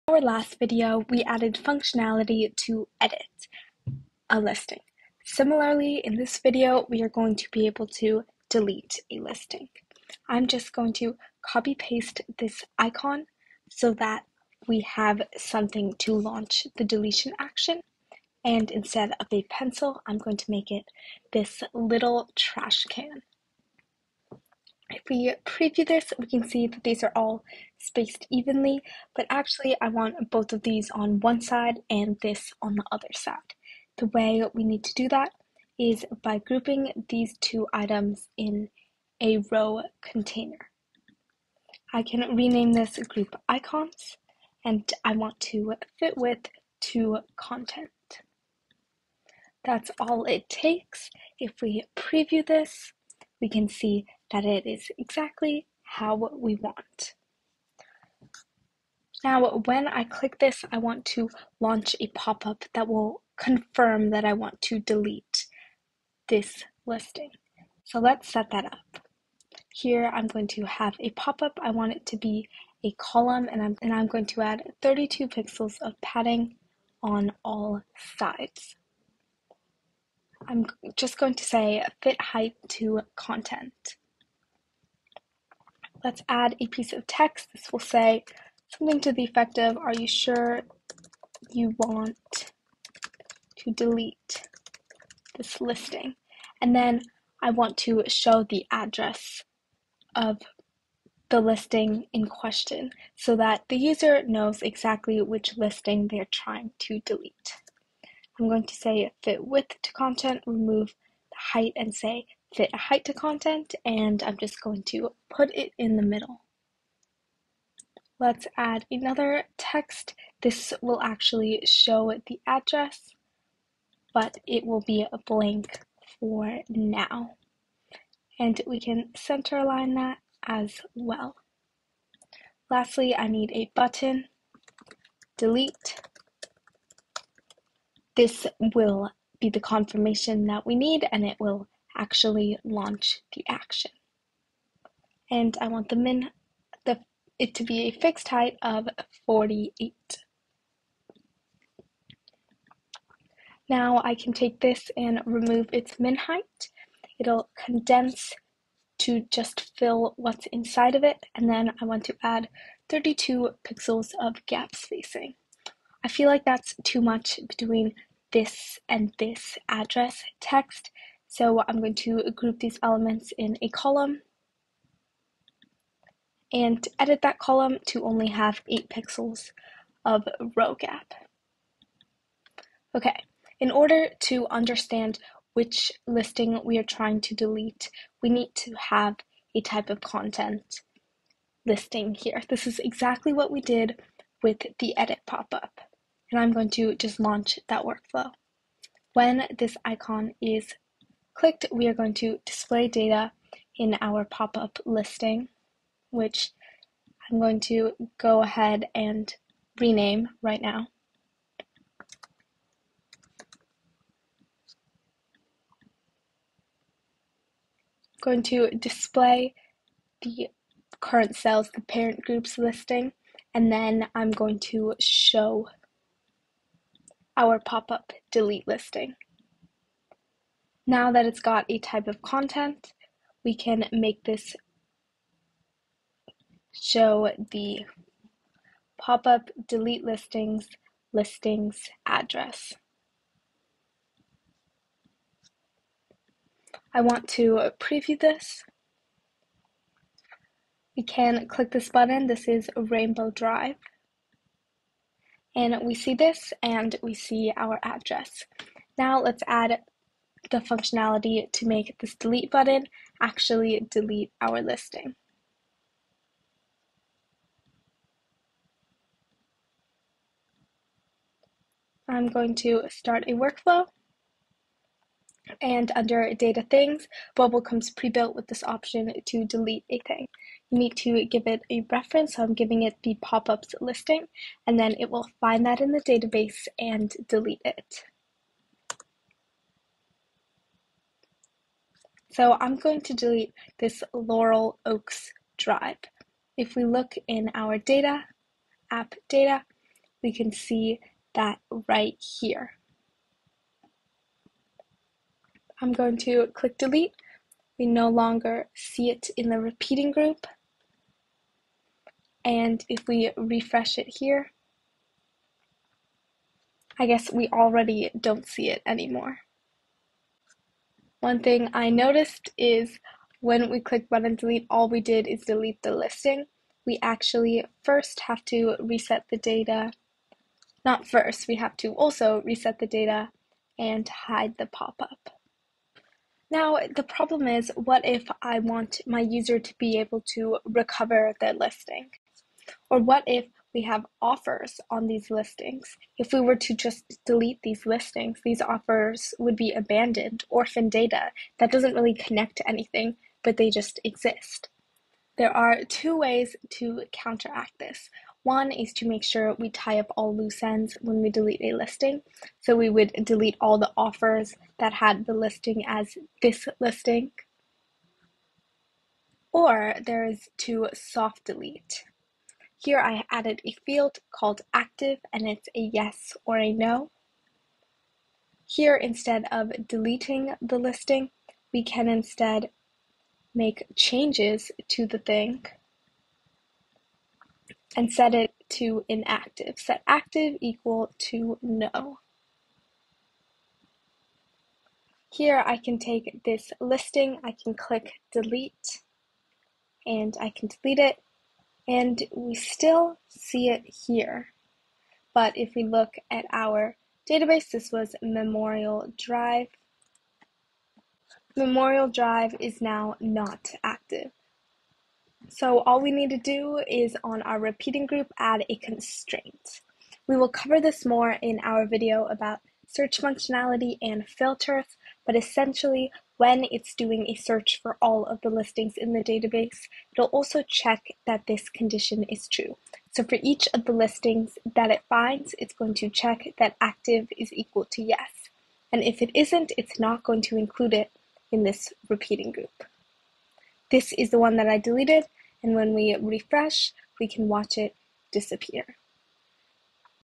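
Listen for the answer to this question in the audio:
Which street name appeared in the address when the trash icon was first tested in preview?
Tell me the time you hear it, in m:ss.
4:12.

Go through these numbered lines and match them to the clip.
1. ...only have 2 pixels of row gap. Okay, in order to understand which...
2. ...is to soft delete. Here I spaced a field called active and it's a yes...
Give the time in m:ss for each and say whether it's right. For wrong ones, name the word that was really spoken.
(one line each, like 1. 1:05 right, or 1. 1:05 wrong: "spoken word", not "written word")
1. 2:58 wrong: "8", not "2"
2. 6:10 wrong: "added", not "spaced".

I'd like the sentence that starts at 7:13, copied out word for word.
So for each of the listings that it finds, it's going to check that active is equal to yes.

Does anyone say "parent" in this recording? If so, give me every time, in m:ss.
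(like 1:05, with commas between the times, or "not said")
3:41.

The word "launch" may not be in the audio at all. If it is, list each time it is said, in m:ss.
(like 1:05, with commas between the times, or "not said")
0:16, 1:01, 2:22, 3:17.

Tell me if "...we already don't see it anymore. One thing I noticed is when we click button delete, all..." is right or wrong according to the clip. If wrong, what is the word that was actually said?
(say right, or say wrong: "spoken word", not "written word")
right.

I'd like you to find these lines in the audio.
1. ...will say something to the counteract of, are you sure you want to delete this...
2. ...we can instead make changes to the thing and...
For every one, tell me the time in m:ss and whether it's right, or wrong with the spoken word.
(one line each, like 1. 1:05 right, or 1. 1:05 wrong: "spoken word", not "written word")
1. 1:27 wrong: "effect", not "counteract"
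2. 6:21 right.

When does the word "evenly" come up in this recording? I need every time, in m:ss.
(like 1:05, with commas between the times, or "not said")
0:28.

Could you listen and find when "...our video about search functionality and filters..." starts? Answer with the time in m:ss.
7:01.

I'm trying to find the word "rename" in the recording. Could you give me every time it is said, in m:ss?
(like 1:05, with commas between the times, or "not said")
0:42, 3:29.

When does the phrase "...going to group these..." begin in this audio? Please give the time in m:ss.
2:51.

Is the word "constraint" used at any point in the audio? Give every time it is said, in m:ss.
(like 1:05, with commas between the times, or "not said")
6:58.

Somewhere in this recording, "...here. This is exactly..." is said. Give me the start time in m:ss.
3:12.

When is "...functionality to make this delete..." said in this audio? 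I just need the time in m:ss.
4:20.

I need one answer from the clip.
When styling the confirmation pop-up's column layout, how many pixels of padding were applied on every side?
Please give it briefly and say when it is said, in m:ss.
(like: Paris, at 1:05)
32, at 1:14.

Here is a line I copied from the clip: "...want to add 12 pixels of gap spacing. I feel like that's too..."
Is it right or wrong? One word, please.
wrong.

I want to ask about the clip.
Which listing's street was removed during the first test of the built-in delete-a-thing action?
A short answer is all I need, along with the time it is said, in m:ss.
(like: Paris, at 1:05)
Laurel Oaks Drive, at 4:54.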